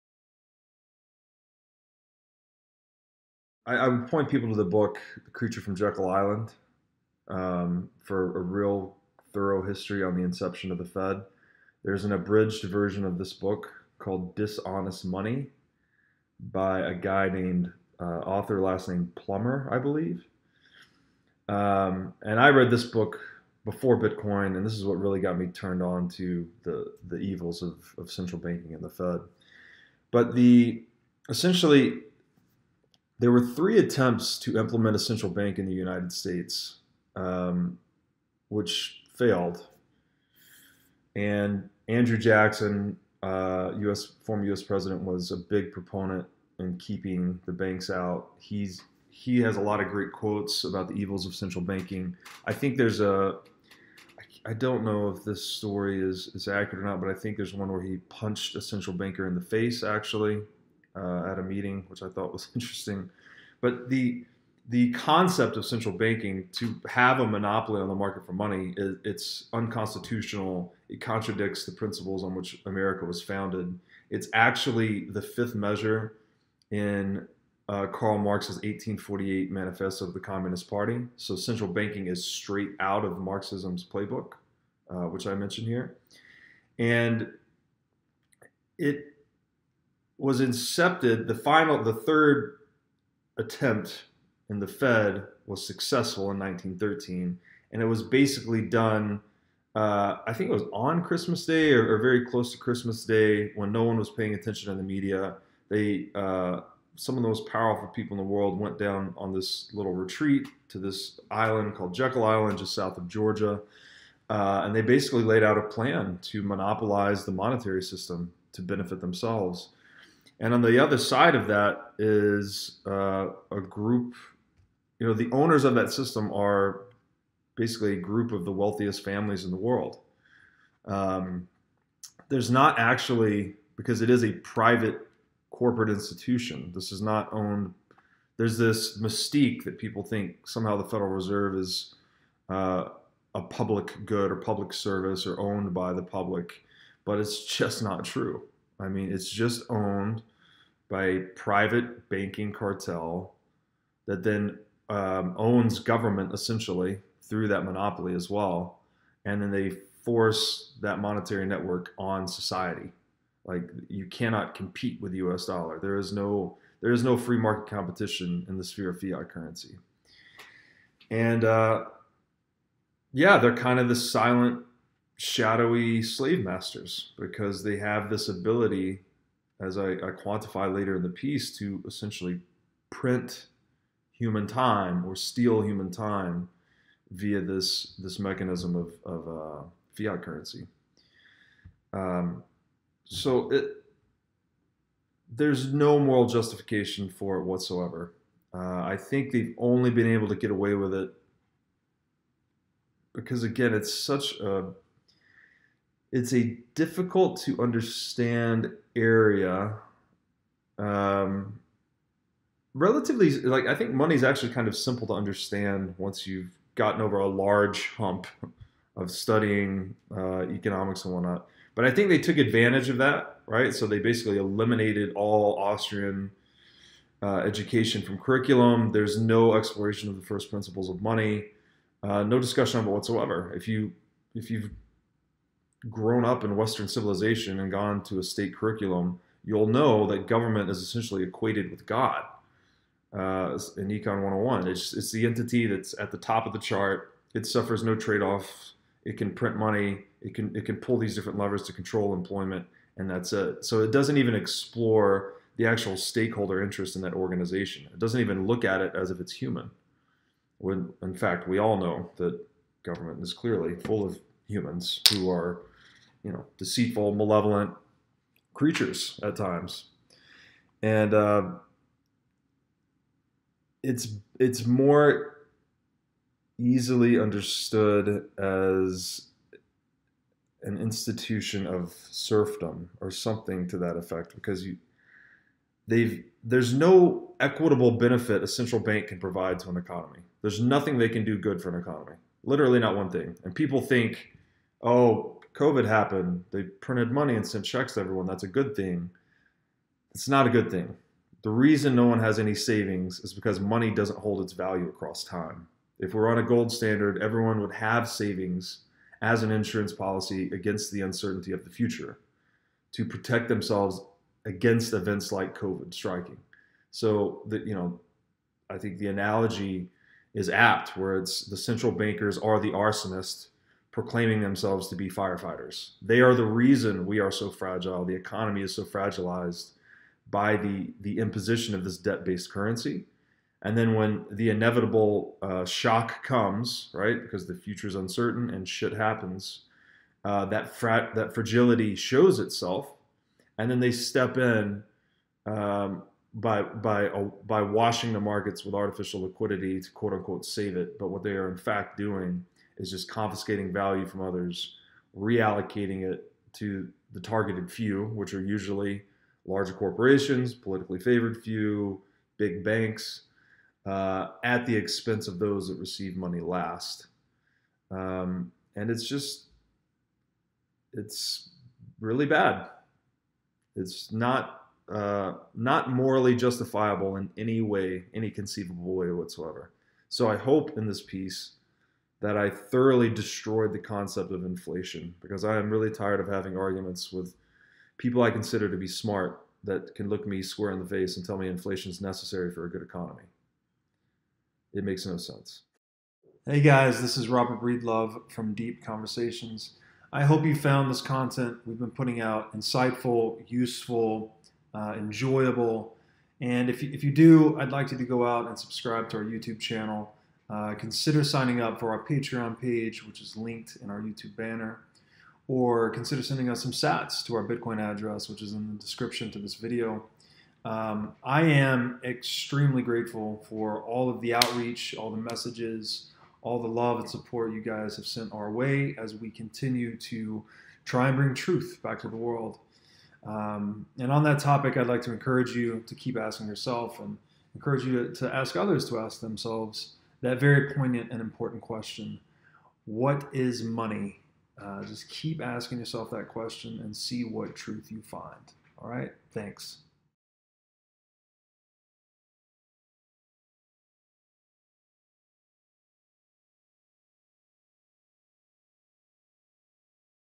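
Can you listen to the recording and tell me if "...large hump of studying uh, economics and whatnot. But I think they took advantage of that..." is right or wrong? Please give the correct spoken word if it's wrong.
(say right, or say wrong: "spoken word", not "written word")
right.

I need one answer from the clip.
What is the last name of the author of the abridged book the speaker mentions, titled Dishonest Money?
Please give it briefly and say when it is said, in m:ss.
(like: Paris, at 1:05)
Plummer, at 0:19.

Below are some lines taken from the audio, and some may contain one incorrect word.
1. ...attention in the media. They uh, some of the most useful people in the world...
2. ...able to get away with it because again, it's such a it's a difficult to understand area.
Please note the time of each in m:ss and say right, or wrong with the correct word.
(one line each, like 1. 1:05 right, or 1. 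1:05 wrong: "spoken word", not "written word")
1. 1:44 wrong: "powerful", not "useful"
2. 3:20 right.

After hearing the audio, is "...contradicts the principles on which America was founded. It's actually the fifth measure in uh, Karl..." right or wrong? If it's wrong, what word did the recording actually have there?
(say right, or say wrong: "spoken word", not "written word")
right.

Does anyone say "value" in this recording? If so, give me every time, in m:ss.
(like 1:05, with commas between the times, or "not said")
5:04, 5:53.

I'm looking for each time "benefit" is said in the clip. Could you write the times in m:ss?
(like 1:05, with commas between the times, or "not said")
1:58, 4:47.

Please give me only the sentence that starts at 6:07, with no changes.
Um, and it's just, it's really bad.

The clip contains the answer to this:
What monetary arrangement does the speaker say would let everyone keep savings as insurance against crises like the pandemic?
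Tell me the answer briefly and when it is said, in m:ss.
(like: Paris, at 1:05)
gold standard, at 5:06.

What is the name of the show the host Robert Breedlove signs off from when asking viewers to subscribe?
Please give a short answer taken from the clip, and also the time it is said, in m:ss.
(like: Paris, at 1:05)
Deep Conversations, at 6:38.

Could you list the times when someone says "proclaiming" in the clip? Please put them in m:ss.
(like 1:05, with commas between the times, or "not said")
5:23.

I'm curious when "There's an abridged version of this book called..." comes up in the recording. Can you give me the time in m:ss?
0:11.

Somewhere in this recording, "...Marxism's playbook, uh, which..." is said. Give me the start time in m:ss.
1:23.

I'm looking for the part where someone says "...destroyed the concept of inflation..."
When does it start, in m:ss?
6:23.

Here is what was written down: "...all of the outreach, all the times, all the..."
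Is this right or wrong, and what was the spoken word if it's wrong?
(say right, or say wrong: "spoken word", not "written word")
wrong: "messages", not "times".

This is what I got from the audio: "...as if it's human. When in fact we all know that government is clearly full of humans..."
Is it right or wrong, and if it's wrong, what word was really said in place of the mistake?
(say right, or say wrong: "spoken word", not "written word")
right.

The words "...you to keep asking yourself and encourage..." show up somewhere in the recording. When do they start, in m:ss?
7:15.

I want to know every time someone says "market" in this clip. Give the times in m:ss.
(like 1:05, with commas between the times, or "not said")
1:07, 2:47, 5:48.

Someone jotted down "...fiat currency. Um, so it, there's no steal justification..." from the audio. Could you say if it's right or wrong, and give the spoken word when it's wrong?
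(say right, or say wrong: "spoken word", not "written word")
wrong: "moral", not "steal".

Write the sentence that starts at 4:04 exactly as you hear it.
It's, it's the entity that's at the top of the chart.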